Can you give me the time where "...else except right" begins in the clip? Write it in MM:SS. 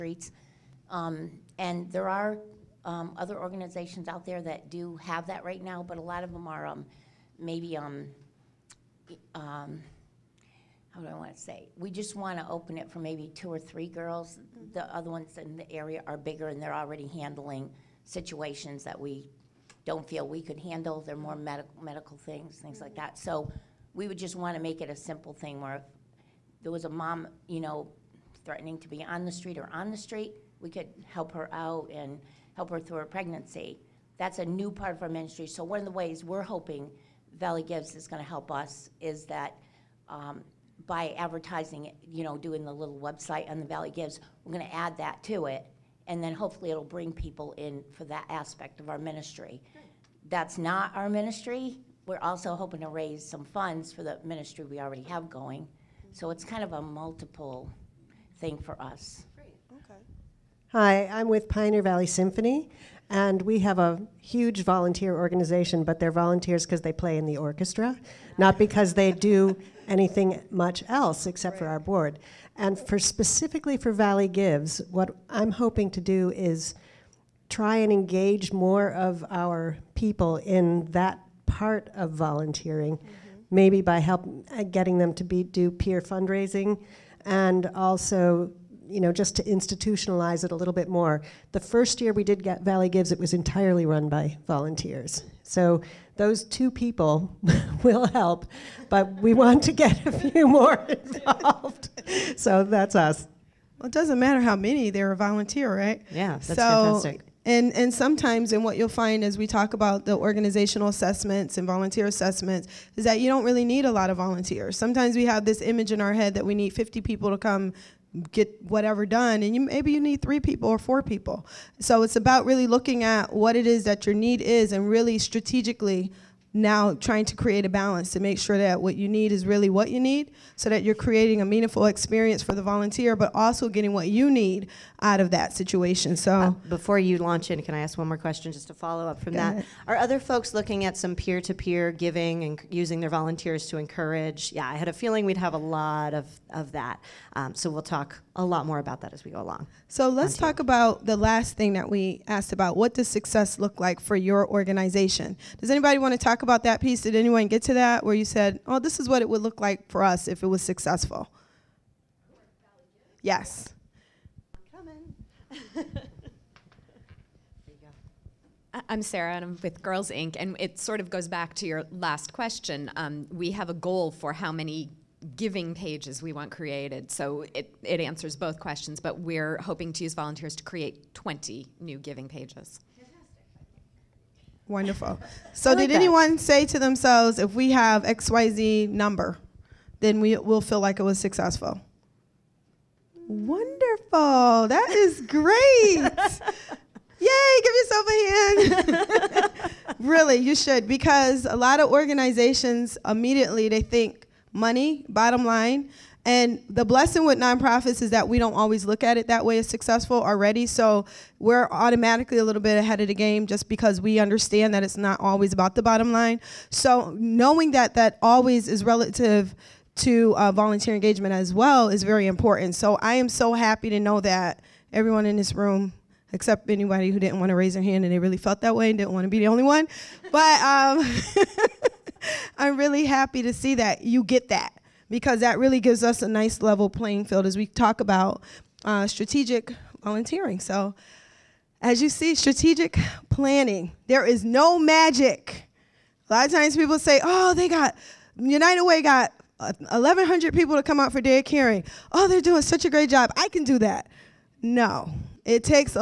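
01:10.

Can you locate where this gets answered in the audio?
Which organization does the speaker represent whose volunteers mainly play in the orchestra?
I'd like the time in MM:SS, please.
01:01.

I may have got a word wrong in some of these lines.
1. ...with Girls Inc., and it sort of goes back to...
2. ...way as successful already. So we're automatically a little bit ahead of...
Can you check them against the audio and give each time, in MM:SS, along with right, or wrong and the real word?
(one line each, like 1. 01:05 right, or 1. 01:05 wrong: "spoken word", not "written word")
1. 02:49 right
2. 03:29 right.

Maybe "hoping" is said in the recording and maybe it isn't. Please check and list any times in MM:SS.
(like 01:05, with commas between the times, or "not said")
00:36, 00:52, 01:15, 02:59.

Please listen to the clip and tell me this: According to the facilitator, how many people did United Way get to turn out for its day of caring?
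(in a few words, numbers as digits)
1,100.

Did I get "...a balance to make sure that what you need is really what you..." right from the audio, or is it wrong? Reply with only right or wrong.
right.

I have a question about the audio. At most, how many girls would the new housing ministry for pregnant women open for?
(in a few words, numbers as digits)
2 or 3.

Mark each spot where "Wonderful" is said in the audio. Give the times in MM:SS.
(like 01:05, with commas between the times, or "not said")
03:04, 03:13.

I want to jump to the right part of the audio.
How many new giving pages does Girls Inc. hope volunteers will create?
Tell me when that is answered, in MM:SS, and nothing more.
03:01.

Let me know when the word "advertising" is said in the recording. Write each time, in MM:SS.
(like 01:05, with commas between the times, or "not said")
00:41.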